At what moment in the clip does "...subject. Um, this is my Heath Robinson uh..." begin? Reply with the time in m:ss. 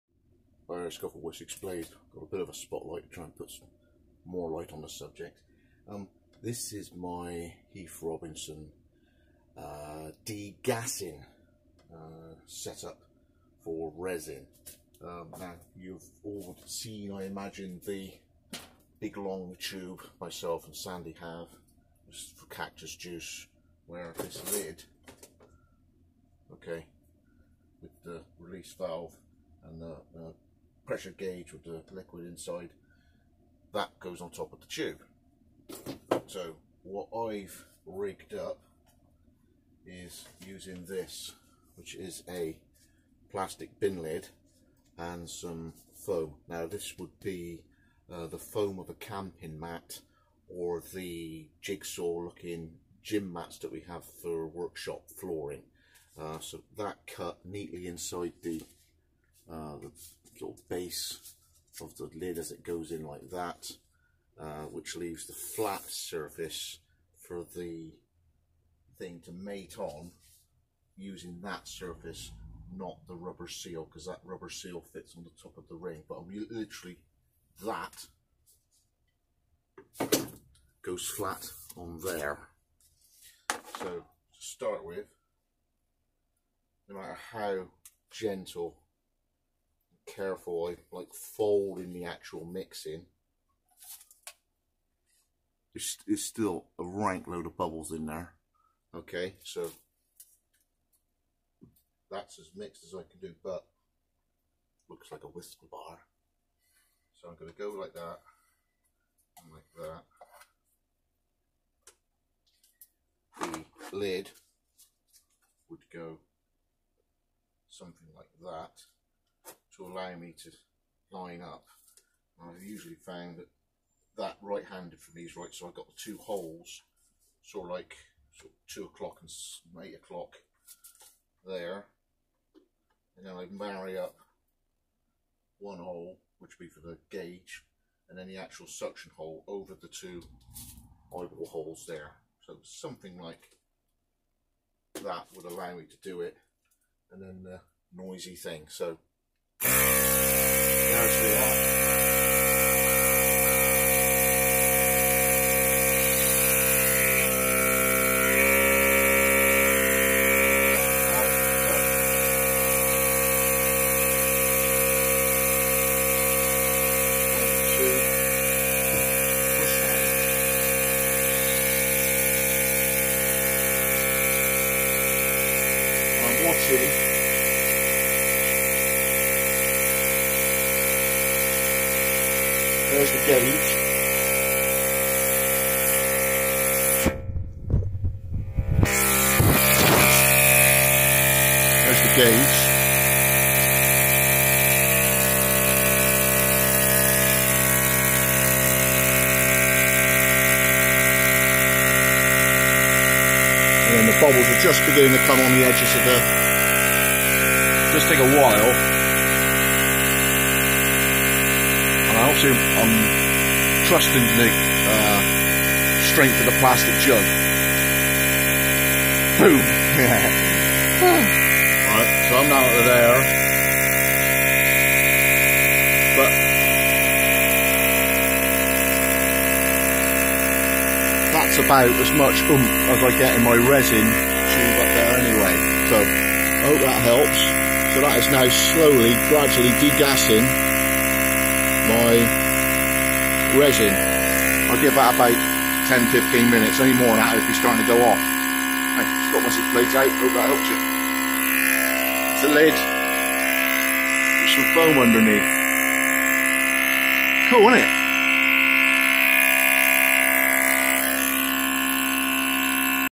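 0:04.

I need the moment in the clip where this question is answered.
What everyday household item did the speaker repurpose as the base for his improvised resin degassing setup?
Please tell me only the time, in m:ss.
0:43.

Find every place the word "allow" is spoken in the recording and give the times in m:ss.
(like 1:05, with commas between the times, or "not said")
1:59, 2:25.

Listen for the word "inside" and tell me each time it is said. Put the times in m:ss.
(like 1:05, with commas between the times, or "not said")
0:32, 0:57.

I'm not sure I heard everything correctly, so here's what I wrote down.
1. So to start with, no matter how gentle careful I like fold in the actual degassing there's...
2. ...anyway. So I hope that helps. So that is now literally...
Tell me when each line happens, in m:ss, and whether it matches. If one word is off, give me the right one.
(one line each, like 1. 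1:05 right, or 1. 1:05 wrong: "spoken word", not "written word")
1. 1:23 wrong: "mixing", not "degassing"
2. 3:55 wrong: "slowly", not "literally".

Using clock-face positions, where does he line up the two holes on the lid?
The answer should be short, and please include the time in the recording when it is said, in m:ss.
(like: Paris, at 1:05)
2 o'clock and 8 o'clock, at 2:08.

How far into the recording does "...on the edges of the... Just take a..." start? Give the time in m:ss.
3:25.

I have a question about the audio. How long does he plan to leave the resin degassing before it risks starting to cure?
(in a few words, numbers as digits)
10 to 15 minutes.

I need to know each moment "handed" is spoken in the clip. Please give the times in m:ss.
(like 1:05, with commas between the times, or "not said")
2:04.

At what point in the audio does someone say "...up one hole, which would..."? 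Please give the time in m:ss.
2:13.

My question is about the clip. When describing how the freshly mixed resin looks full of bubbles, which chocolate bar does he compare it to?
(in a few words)
Wispa bar.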